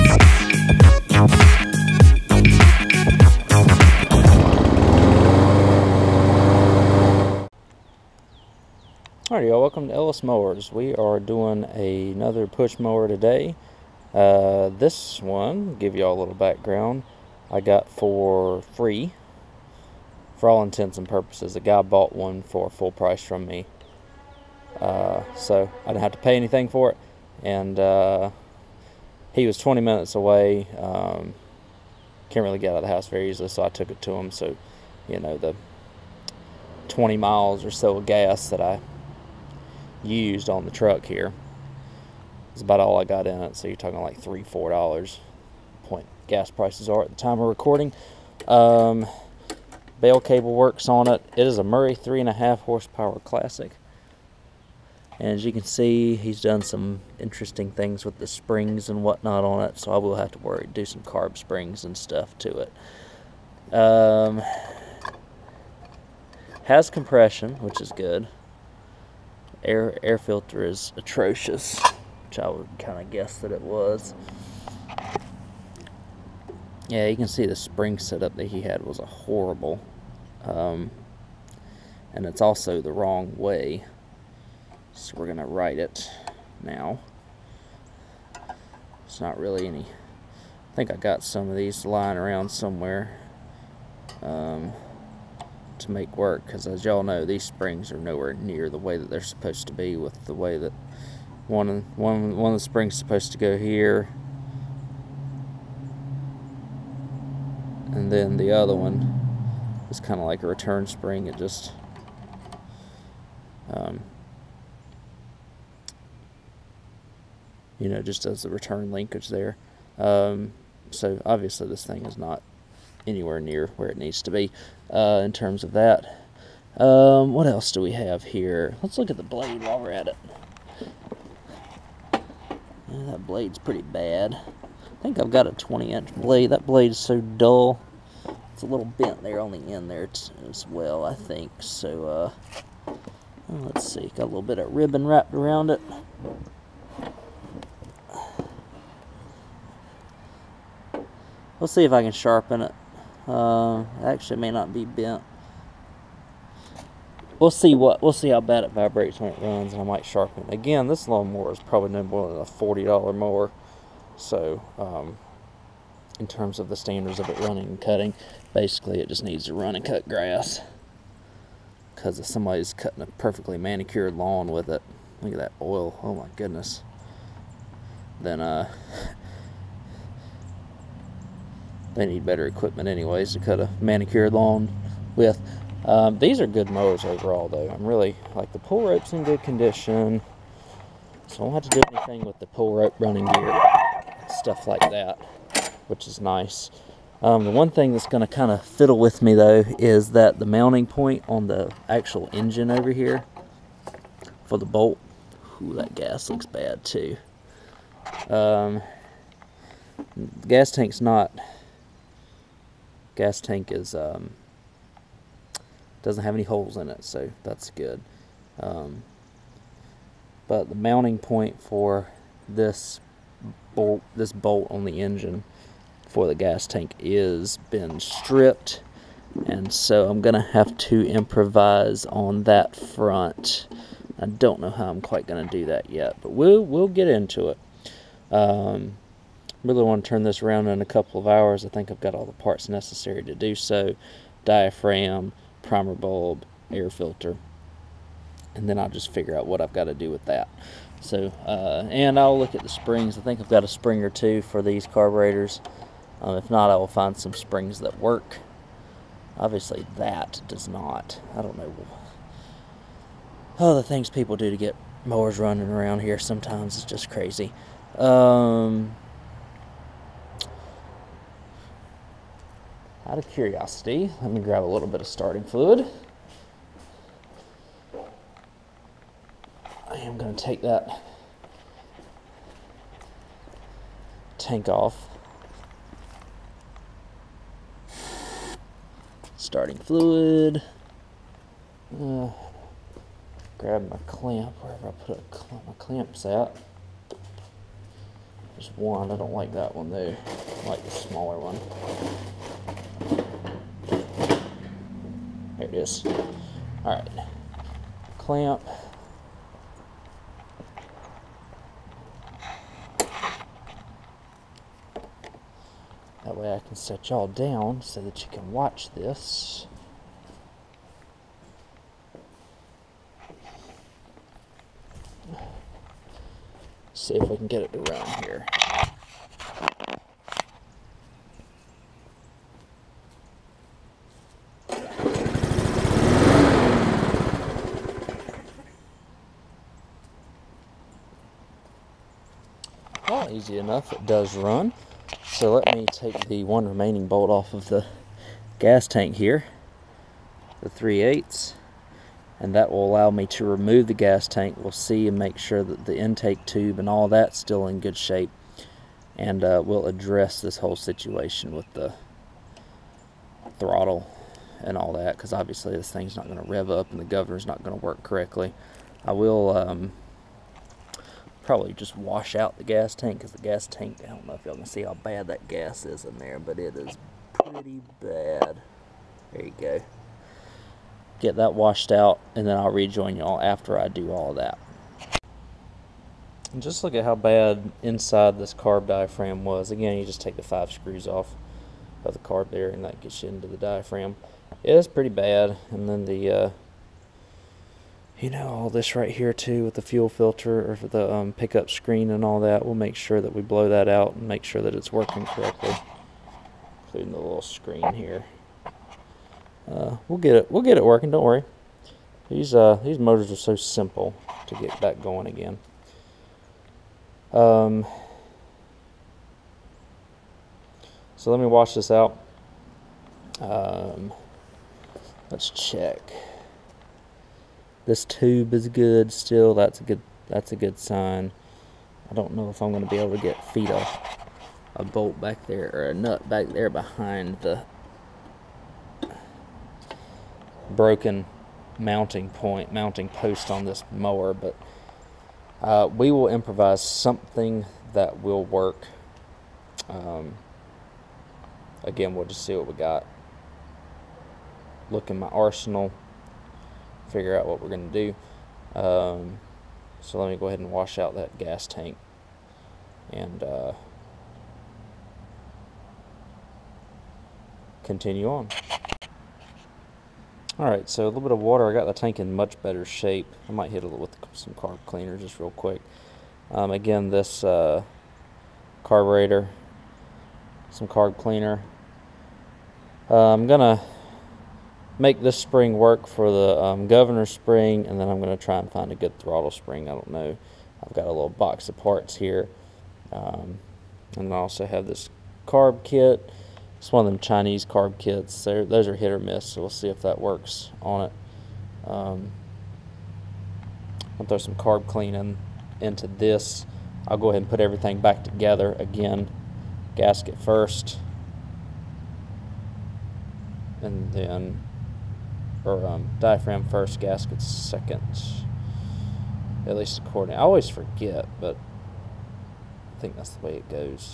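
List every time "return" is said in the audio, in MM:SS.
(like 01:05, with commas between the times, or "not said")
01:50, 01:58.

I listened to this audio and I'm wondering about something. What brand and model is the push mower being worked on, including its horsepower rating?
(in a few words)
Murray 3.5 horsepower classic.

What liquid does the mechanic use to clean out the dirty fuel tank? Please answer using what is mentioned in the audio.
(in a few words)
water.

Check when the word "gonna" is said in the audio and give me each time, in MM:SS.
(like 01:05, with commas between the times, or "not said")
01:25, 03:18, 03:50, 03:55.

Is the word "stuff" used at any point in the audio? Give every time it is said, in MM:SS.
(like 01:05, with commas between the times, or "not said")
01:01, 03:14.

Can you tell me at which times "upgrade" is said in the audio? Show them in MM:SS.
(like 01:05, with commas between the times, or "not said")
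not said.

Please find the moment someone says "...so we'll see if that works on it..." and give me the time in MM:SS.
08:19.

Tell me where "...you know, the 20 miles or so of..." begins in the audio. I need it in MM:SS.
00:35.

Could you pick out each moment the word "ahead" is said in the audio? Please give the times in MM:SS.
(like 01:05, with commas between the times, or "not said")
07:40, 08:27.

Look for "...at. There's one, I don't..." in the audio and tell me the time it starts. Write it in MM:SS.
04:56.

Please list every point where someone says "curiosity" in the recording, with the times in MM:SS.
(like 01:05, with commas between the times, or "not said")
04:33.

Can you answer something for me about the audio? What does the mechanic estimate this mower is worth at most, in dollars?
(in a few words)
$40.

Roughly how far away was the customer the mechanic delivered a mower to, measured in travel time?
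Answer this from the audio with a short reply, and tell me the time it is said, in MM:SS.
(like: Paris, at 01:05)
20 minutes, at 00:29.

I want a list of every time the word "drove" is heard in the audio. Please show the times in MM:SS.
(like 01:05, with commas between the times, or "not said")
not said.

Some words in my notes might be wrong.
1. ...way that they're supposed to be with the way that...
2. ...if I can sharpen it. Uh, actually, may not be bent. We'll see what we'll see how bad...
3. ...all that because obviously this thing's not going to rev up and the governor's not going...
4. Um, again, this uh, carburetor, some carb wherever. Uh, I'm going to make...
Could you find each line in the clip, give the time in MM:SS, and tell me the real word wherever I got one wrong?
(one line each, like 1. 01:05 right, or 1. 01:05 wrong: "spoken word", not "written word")
1. 01:38 right
2. 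02:31 right
3. 06:04 right
4. 07:56 wrong: "cleaner", not "wherever".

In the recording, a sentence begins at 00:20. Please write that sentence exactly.
For all intents and purposes, a guy bought one for full price from me.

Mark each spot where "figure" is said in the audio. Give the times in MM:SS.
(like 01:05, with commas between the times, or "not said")
04:09, 07:37.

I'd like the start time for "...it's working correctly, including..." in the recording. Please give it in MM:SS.
06:44.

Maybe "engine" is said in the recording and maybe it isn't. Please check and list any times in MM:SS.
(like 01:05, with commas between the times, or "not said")
03:22, 03:45.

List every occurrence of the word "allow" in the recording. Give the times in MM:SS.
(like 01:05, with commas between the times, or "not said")
05:52.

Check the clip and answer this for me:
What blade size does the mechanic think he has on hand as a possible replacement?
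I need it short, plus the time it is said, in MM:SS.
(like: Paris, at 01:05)
20-inch, at 02:15.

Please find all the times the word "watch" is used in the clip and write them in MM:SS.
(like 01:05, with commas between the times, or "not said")
05:18.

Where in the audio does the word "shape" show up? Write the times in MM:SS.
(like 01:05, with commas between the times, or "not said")
05:57, 07:52.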